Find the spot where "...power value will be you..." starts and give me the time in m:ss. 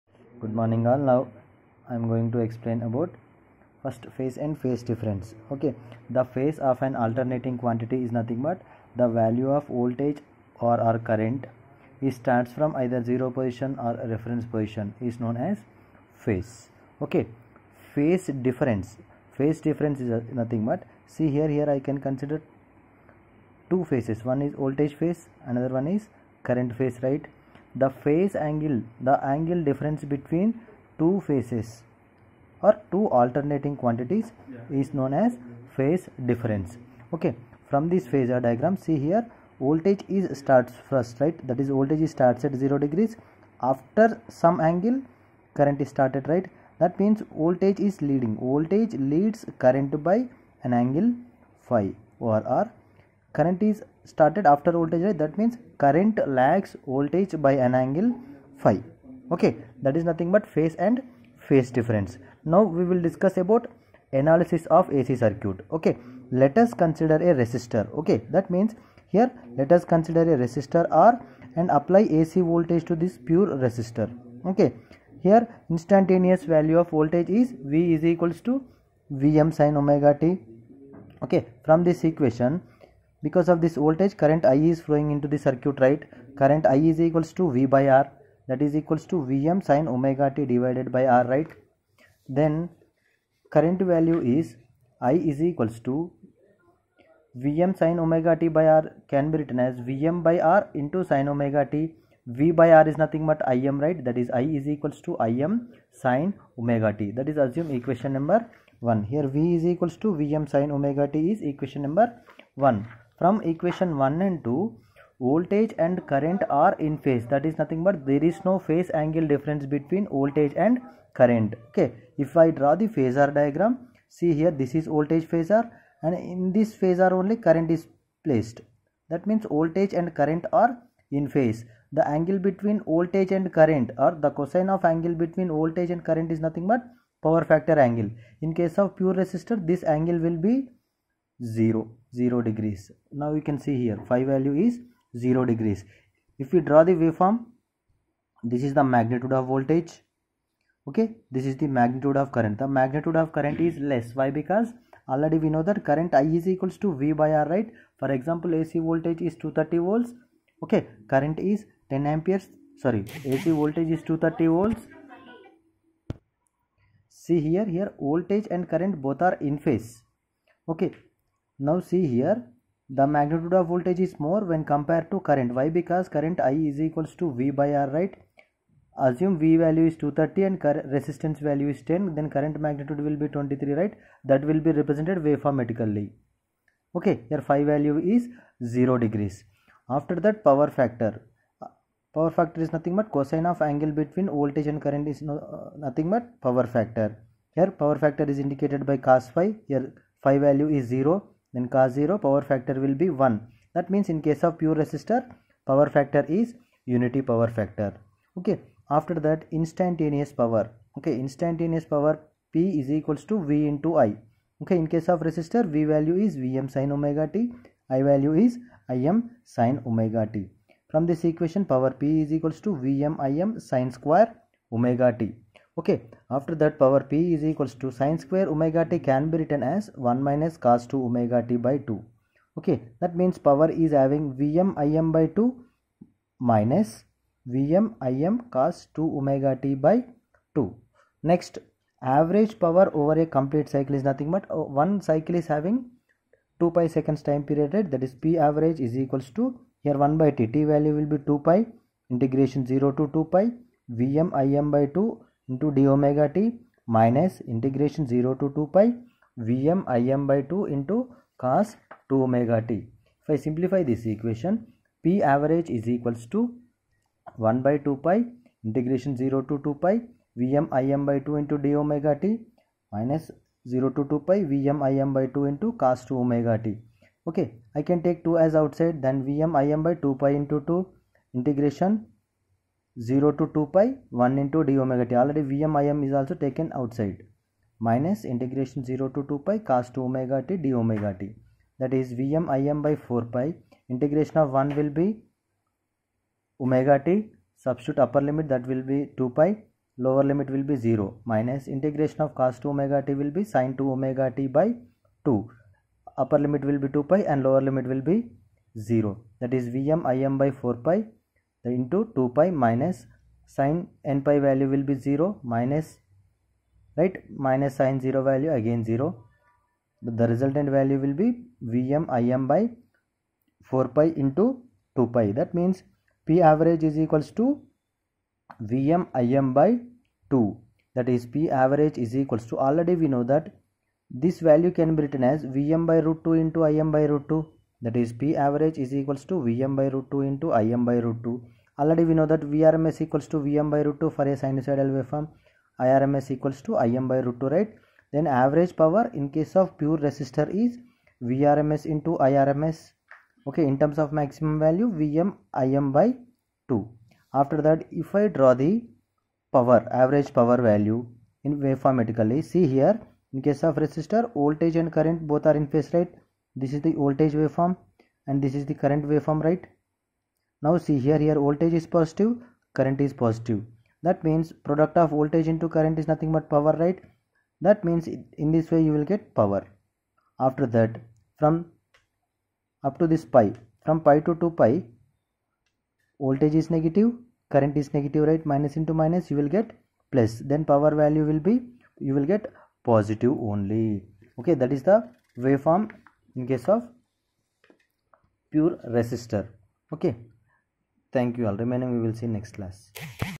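6:30.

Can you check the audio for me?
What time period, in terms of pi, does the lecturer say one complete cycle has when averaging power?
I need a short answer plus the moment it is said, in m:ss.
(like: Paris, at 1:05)
2 pi, at 4:06.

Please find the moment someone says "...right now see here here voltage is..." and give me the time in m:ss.
6:09.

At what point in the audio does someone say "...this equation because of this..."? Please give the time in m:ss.
1:21.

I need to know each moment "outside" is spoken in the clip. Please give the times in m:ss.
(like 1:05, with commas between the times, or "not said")
4:38, 4:46.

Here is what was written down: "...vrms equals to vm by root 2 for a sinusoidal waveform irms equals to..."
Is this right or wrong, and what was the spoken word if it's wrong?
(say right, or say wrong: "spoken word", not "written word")
right.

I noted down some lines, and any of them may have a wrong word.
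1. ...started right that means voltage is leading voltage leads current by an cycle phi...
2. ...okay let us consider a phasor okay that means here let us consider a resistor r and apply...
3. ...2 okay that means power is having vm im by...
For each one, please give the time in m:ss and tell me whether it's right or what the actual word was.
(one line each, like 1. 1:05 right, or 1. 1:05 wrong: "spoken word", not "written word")
1. 0:45 wrong: "angle", not "cycle"
2. 1:05 wrong: "resistor", not "phasor"
3. 3:51 right.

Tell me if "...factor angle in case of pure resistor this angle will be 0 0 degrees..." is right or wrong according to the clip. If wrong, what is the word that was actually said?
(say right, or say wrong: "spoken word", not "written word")
right.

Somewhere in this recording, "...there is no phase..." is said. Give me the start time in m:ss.
1:58.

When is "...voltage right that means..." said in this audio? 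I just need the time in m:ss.
0:54.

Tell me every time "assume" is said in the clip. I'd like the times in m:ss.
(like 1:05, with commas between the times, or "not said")
1:47, 2:59.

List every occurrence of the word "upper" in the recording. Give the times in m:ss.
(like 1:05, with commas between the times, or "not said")
4:58, 5:06.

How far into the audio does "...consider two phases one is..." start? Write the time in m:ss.
0:22.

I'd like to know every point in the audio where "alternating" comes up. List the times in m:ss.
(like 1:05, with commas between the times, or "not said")
0:07, 0:33.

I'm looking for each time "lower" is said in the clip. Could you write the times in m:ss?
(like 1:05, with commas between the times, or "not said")
5:00, 5:07.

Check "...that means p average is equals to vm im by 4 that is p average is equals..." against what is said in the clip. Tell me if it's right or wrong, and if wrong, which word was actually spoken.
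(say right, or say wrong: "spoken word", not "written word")
wrong: "2", not "4".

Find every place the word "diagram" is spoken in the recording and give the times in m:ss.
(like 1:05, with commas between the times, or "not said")
0:38, 2:03.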